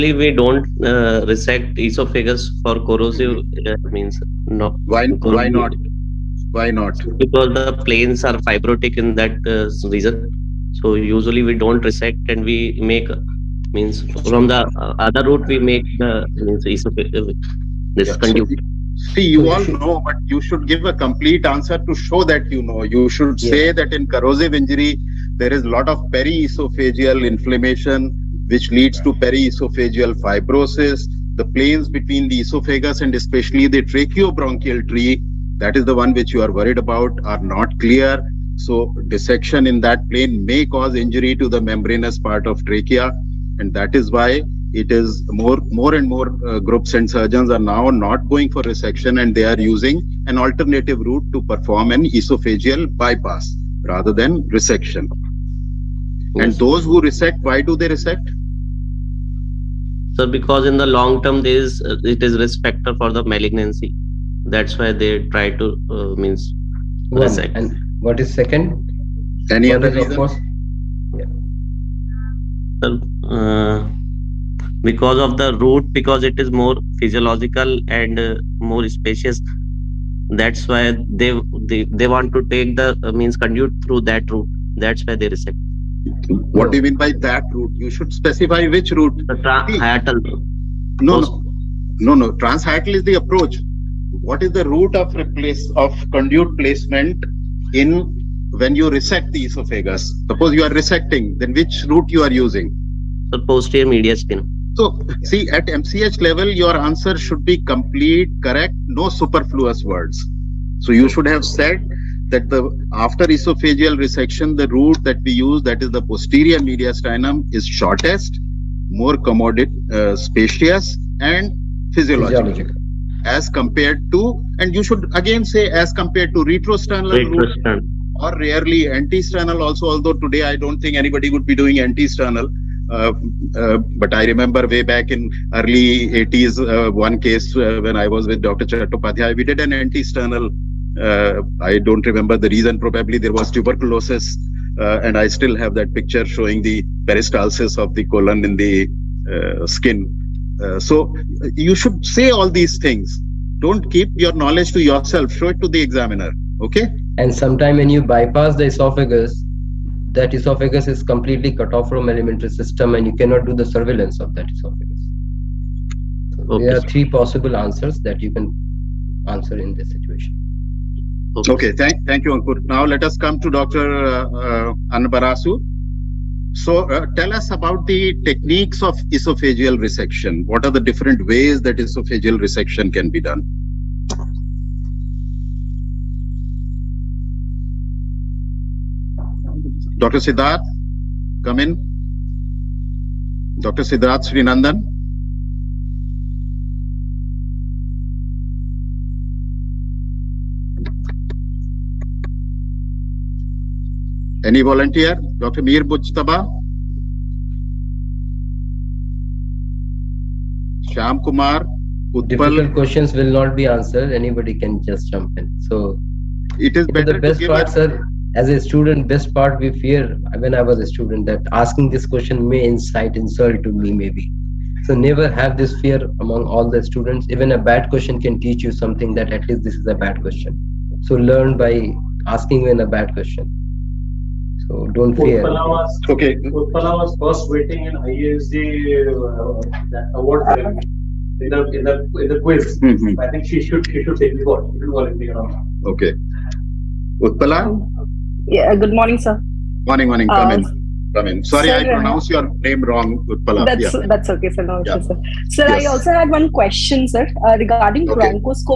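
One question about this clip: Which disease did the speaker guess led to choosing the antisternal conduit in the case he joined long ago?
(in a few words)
Tuberculosis.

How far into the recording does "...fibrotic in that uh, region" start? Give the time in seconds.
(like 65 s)
8 s.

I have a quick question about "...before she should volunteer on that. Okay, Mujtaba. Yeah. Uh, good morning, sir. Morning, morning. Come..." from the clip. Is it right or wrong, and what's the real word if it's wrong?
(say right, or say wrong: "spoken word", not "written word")
wrong: "Utpala", not "Mujtaba".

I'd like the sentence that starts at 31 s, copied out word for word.
The planes between the esophagus and especially the tracheobronchial tree that is the one which you are worried about, are not clear.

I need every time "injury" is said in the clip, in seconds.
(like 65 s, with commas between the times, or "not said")
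24 s, 41 s.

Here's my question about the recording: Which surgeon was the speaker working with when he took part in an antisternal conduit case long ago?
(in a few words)
Dr. Chattopadhyay.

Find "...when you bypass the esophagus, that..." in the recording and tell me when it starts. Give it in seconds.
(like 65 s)
157 s.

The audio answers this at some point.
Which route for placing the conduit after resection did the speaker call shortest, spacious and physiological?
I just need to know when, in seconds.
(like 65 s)
116 s.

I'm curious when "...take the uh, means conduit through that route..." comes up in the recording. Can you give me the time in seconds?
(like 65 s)
82 s.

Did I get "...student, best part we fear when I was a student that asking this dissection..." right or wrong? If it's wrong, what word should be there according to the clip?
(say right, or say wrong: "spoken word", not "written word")
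wrong: "question", not "dissection".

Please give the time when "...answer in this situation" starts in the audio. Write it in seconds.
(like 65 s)
169 s.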